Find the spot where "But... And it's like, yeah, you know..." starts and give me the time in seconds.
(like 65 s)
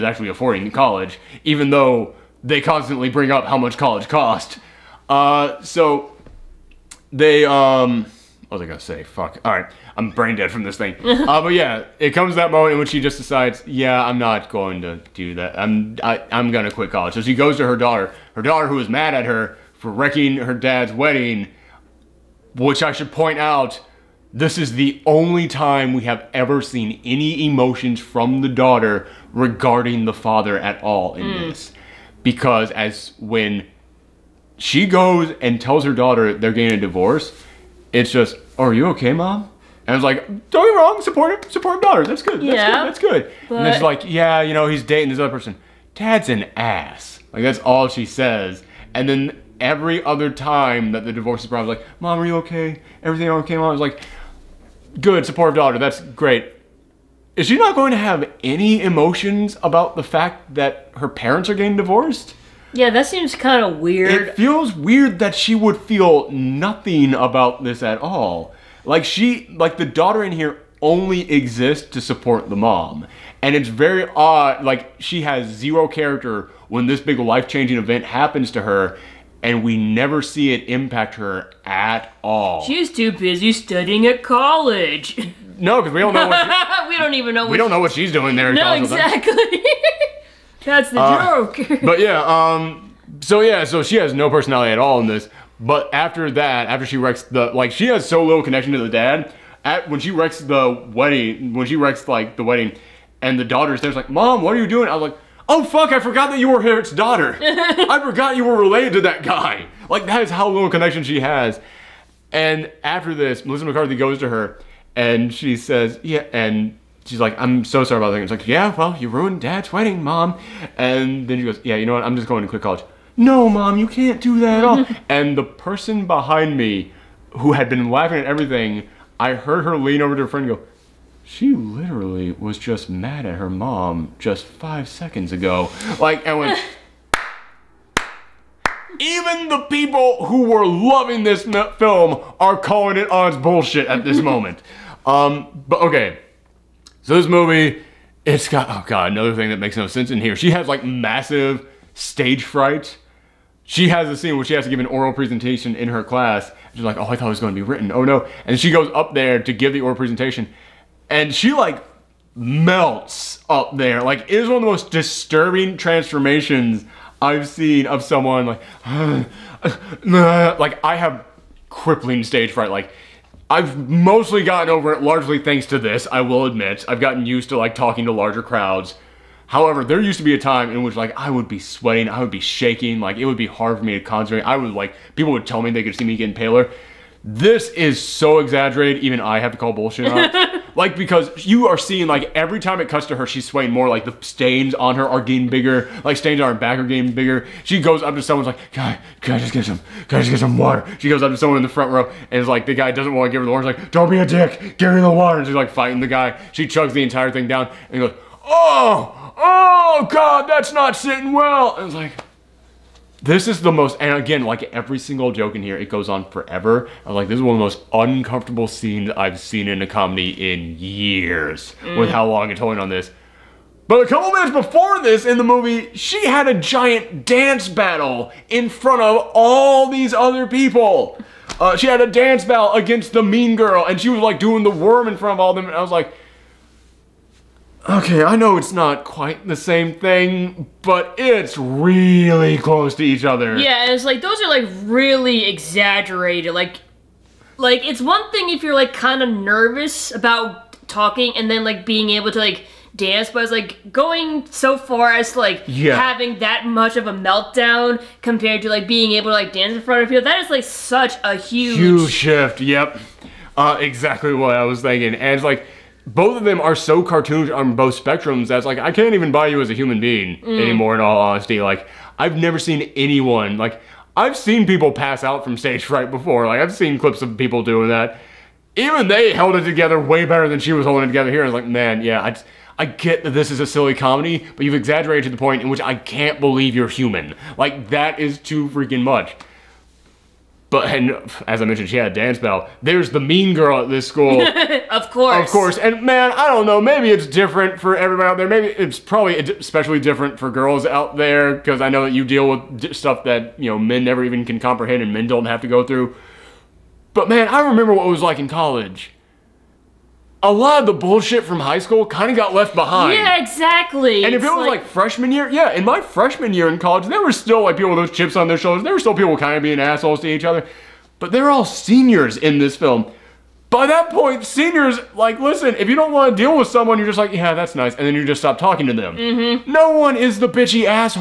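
43 s.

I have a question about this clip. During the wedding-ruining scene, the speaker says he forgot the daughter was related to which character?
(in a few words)
Herrick.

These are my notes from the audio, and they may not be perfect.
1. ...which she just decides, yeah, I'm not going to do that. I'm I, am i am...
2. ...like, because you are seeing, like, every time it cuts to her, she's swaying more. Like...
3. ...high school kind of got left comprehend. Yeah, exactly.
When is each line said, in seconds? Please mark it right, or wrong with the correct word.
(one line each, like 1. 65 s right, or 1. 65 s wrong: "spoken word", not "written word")
1. 12 s right
2. 190 s right
3. 311 s wrong: "behind", not "comprehend".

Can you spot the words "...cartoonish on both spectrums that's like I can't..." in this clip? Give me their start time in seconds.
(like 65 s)
267 s.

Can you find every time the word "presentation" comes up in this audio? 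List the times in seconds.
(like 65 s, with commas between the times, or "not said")
155 s, 159 s.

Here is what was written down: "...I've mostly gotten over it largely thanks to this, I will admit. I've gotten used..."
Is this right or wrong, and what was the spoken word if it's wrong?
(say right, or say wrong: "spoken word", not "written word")
right.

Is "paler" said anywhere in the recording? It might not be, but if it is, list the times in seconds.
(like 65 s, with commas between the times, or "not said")
186 s.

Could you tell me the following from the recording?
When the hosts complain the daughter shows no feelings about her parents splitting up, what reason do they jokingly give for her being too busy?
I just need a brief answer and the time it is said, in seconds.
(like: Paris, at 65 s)
Studying at college, at 83 s.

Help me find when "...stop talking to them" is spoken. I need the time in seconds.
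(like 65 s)
328 s.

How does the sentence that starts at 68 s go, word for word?
Like she, like the daughter in here only exists to support the mom.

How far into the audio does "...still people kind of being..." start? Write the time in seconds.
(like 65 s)
318 s.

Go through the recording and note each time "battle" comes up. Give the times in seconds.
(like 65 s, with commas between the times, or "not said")
227 s, 232 s, 292 s.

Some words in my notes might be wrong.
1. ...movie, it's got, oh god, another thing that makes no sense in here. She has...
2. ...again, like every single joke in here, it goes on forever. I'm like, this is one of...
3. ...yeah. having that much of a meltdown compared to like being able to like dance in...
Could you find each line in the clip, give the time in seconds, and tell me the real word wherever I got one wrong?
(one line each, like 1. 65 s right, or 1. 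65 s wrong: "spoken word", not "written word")
1. 147 s right
2. 214 s right
3. 255 s right.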